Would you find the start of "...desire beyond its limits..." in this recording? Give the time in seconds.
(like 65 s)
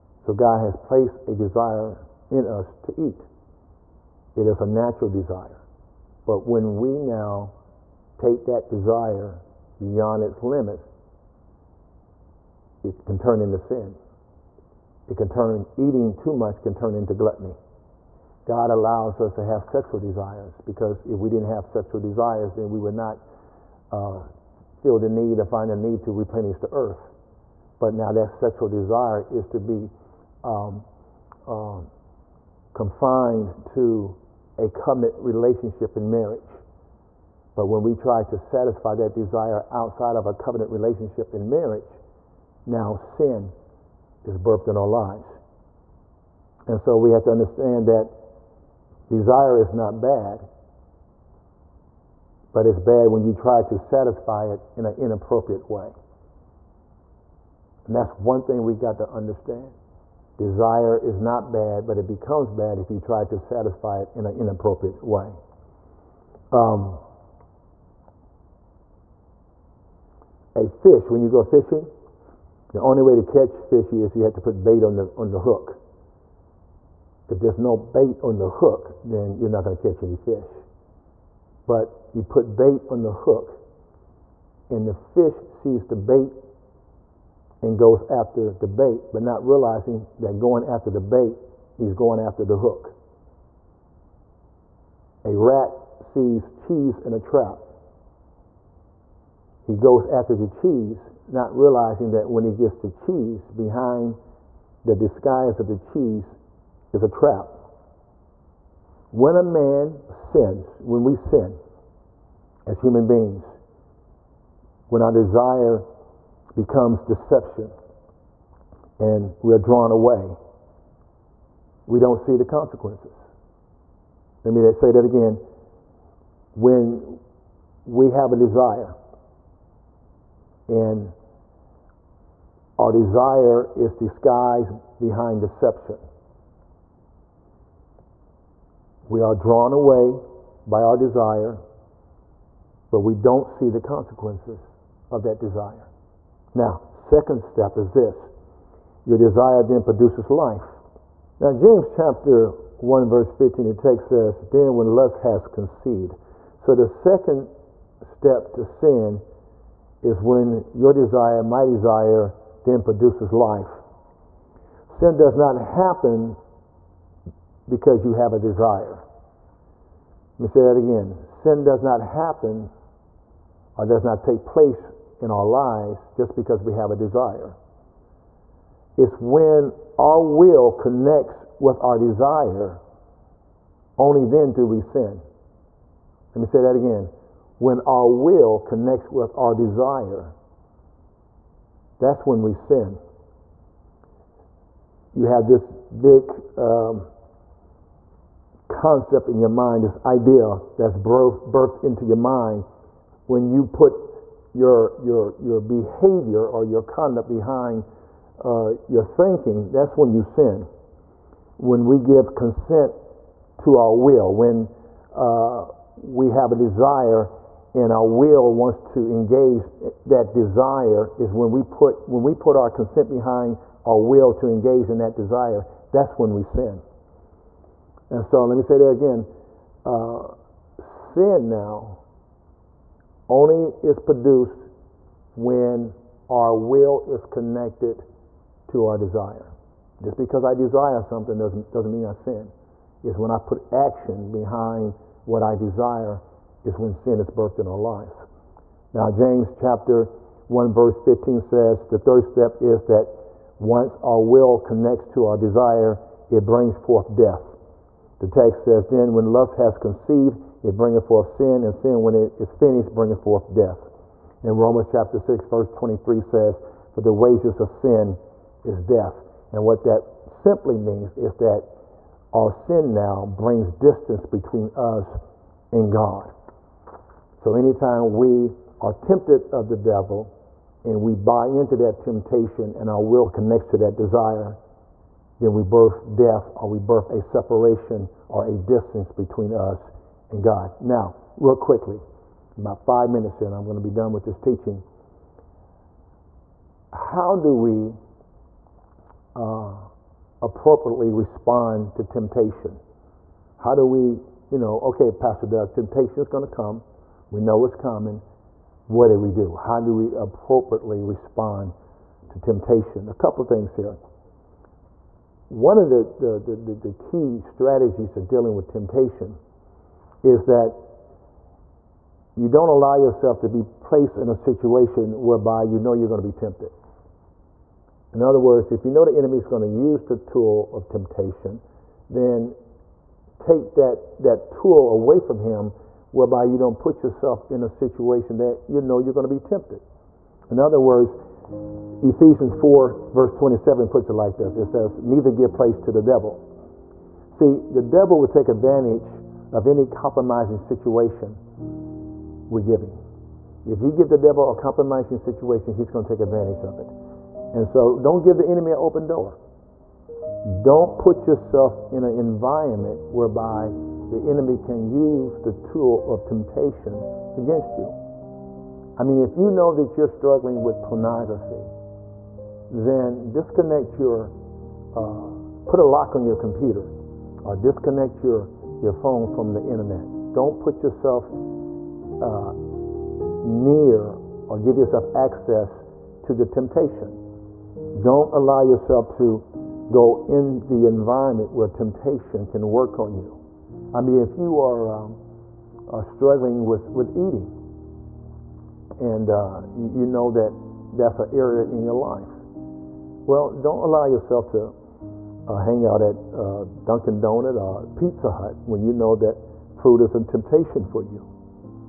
8 s.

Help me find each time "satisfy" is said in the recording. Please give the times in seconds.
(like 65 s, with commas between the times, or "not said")
38 s, 53 s, 63 s.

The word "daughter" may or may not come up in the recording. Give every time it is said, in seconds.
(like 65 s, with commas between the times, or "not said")
not said.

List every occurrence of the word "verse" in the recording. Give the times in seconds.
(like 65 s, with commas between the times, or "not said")
153 s, 250 s, 265 s, 343 s.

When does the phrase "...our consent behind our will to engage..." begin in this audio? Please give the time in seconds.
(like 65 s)
222 s.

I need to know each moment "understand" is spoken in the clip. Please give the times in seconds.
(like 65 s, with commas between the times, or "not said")
47 s, 59 s.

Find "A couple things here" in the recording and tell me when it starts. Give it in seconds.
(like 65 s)
313 s.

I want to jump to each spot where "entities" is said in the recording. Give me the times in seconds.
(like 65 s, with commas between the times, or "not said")
not said.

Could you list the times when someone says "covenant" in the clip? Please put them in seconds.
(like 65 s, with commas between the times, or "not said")
34 s, 40 s.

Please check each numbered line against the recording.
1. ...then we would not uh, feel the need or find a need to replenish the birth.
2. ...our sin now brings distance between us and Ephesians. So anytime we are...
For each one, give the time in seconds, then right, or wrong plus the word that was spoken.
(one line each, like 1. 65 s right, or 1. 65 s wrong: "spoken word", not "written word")
1. 22 s wrong: "earth", not "birth"
2. 272 s wrong: "God", not "Ephesians".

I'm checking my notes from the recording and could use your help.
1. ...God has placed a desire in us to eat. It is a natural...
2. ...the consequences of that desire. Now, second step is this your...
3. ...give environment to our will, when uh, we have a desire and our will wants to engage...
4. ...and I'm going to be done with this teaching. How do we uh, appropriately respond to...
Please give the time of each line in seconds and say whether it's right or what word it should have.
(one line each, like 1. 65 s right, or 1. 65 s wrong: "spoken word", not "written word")
1. 0 s right
2. 143 s right
3. 211 s wrong: "consent", not "environment"
4. 293 s right.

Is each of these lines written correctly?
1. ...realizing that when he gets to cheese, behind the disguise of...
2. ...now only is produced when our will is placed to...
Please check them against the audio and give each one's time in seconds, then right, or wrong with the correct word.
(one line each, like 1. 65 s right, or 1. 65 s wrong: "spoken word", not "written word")
1. 101 s right
2. 231 s wrong: "connected", not "placed".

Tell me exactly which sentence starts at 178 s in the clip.
It's when our will connects with our desire, only then do we sin.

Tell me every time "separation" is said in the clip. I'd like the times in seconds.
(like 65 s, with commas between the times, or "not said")
287 s.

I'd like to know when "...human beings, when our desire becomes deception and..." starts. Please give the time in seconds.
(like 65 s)
112 s.